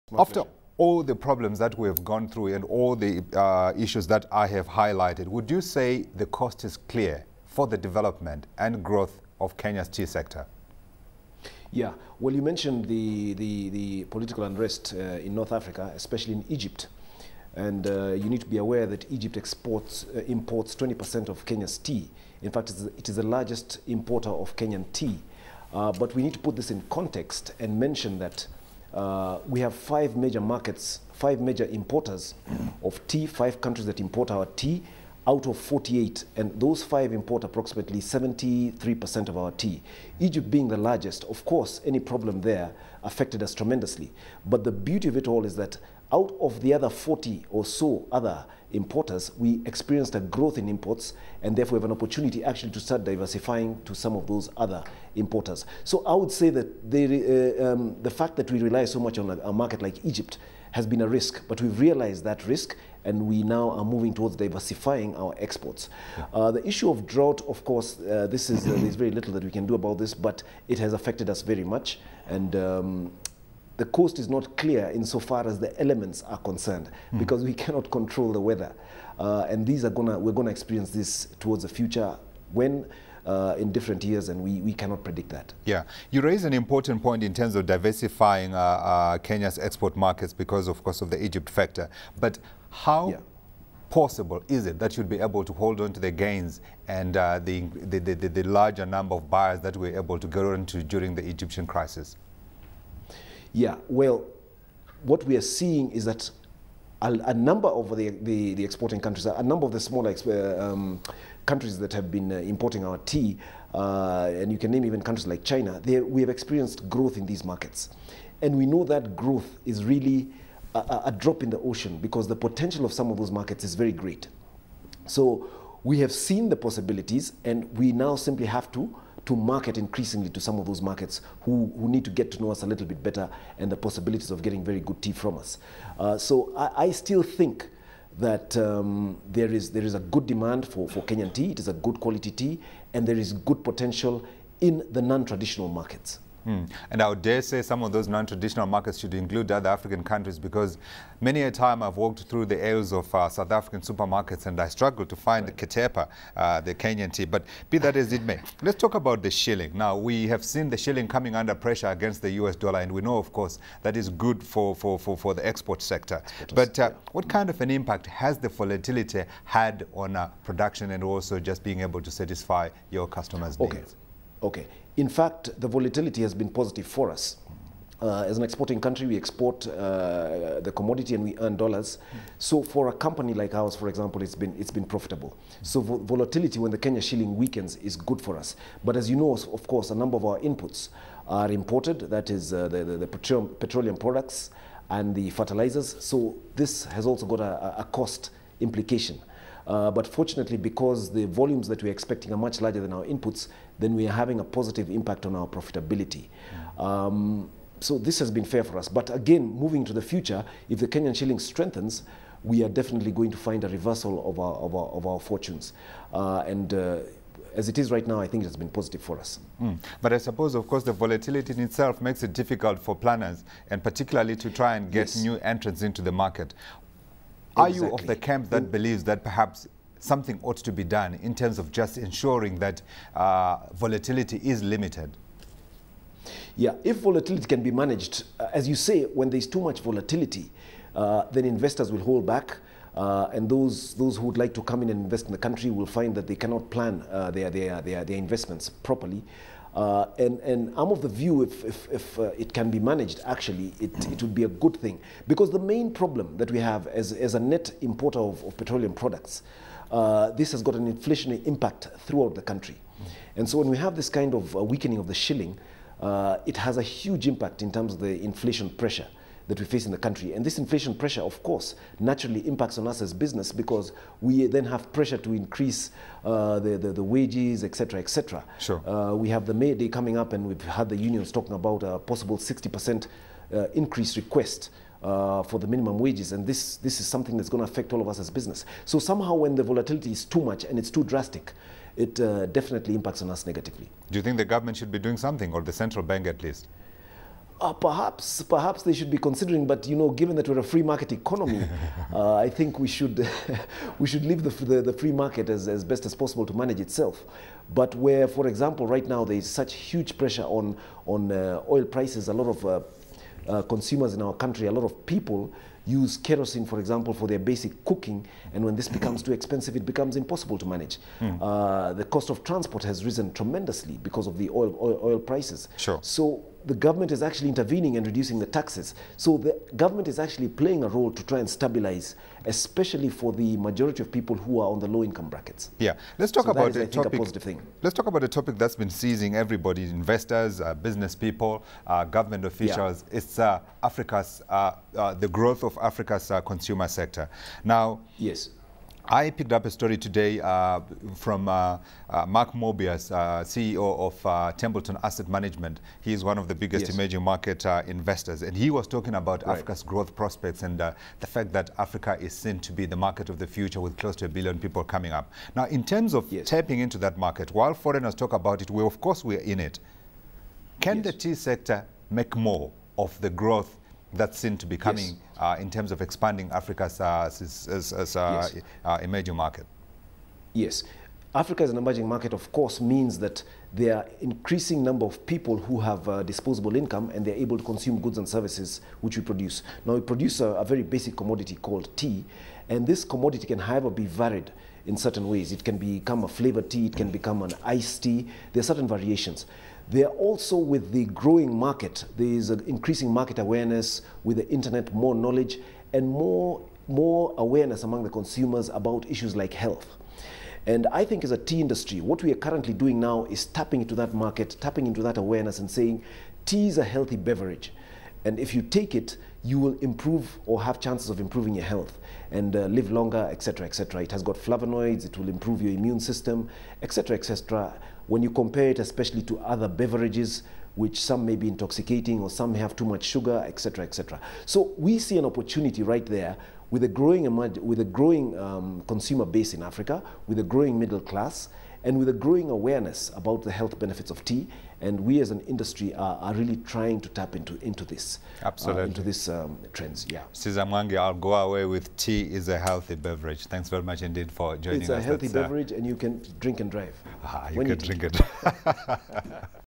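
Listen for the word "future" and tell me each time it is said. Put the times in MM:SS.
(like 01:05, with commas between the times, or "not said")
01:21, 03:30, 06:03.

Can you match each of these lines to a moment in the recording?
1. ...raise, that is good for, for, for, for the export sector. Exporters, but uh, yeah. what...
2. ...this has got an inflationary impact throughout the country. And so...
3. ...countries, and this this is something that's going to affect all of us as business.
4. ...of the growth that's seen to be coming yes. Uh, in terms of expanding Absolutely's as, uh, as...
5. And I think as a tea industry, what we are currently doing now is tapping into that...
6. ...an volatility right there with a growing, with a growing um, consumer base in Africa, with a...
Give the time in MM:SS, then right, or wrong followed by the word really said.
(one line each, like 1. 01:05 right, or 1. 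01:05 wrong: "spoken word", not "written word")
1. 02:43 wrong: "course", not "raise"
2. 04:20 right
3. 04:45 wrong: "wages", not "countries"
4. 06:12 wrong: "Africa", not "Absolutely"
5. 06:50 right
6. 07:15 wrong: "opportunity", not "volatility".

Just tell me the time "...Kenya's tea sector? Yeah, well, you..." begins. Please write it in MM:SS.
00:09.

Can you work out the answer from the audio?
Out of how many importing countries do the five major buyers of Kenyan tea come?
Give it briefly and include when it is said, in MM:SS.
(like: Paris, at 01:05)
48, at 00:35.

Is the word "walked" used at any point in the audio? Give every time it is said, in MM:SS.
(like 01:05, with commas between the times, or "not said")
02:31.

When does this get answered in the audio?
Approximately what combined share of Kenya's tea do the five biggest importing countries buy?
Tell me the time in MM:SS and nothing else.
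00:37.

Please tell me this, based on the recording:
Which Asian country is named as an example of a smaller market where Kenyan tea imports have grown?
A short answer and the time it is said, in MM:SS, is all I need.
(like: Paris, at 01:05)
China, at 01:55.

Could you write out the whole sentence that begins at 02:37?
But be that as it may, let's talk about the shilling.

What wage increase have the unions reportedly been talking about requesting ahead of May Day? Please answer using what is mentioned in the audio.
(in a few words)
60%.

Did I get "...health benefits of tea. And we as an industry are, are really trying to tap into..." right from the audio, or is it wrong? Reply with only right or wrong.
right.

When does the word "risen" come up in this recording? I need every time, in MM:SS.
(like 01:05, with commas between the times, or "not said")
05:23.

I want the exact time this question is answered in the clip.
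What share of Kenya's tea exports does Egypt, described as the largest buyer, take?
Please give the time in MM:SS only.
00:20.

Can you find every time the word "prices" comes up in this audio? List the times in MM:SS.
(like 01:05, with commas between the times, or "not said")
05:11, 05:25.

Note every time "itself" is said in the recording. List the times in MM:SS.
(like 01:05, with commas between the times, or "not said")
03:41, 05:06.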